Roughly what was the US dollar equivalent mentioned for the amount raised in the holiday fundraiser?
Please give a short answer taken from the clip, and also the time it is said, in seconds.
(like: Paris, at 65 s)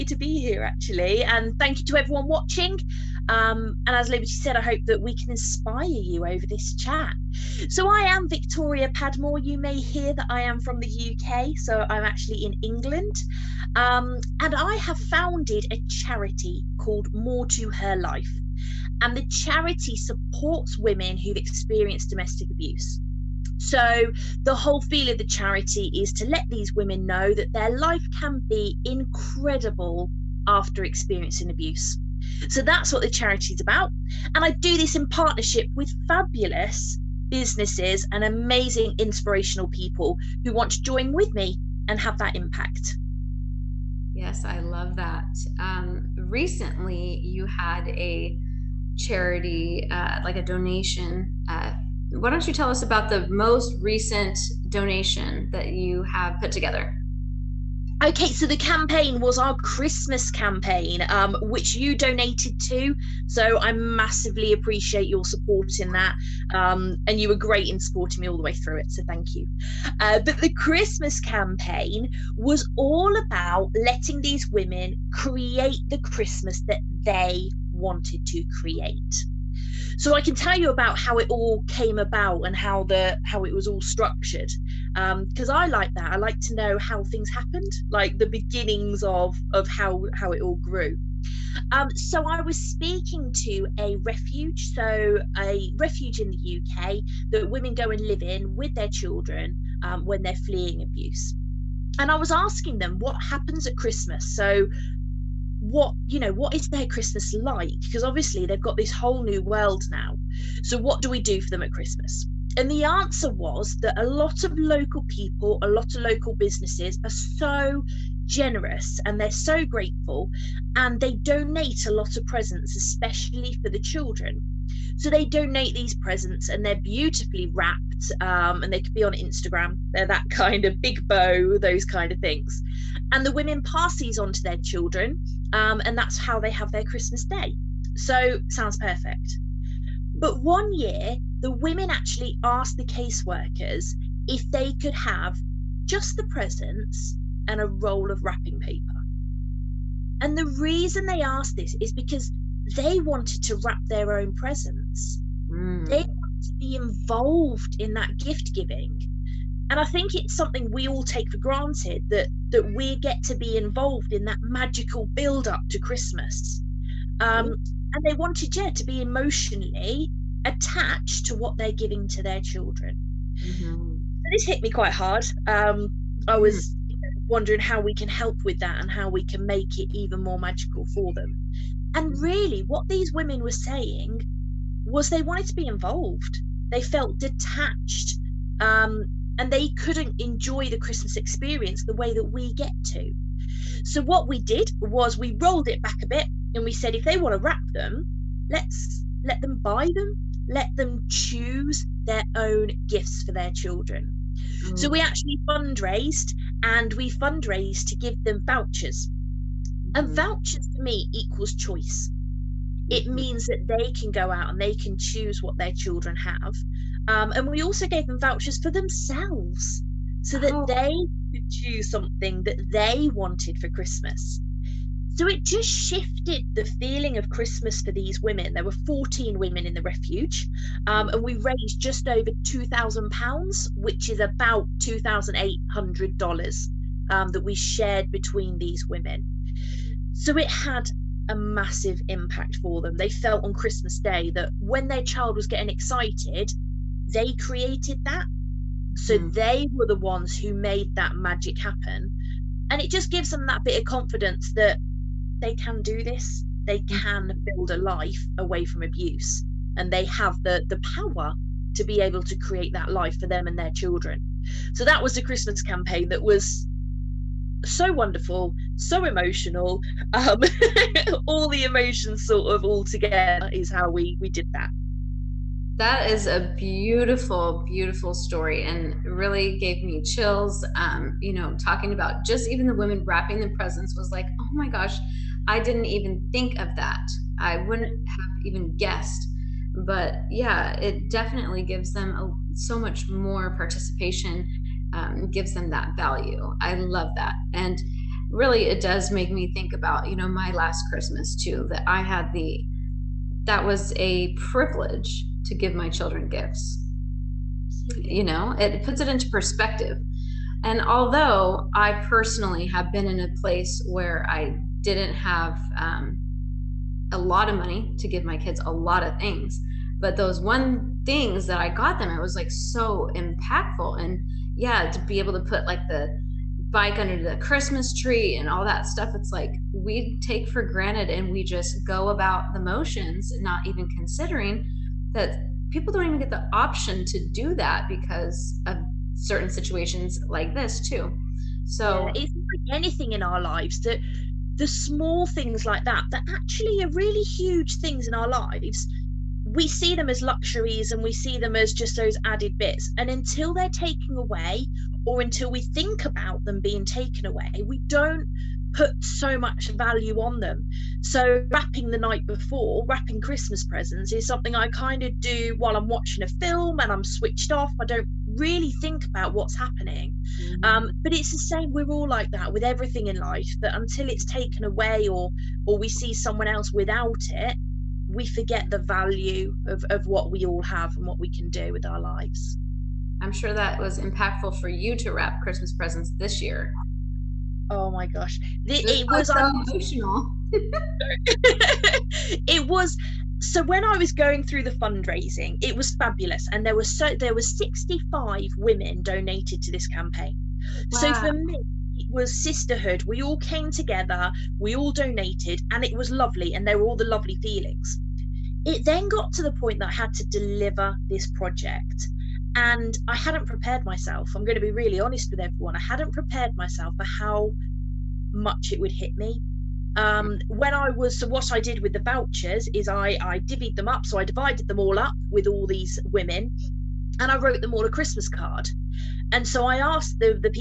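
$2,800, at 234 s.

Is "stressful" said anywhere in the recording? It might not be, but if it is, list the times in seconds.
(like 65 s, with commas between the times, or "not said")
not said.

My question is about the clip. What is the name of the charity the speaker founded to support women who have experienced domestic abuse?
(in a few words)
More to Her Life.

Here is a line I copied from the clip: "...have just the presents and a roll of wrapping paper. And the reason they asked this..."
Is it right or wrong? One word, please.
right.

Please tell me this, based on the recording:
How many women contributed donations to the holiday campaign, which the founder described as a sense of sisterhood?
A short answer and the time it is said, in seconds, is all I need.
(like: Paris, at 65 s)
65, at 397 s.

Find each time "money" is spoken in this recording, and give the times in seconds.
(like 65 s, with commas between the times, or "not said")
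317 s.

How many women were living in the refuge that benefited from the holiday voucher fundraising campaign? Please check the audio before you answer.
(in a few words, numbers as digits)
14.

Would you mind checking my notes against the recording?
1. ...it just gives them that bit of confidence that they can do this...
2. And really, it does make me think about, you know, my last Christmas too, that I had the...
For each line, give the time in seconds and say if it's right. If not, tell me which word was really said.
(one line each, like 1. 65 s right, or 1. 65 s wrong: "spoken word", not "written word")
1. 252 s right
2. 297 s right.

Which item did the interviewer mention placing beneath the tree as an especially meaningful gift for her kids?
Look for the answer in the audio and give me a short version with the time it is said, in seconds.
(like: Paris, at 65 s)
bike, at 326 s.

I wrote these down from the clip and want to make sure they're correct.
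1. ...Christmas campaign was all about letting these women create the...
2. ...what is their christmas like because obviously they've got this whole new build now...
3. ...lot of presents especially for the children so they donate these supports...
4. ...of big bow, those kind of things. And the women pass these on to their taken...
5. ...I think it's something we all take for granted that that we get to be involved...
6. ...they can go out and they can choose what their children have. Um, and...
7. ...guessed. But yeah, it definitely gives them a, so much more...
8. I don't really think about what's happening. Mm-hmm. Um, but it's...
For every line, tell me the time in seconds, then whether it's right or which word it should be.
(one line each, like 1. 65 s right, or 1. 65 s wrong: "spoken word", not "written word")
1. 70 s right
2. 106 s wrong: "world", not "build"
3. 121 s wrong: "presents", not "supports"
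4. 130 s wrong: "children", not "taken"
5. 159 s right
6. 213 s right
7. 288 s right
8. 367 s right.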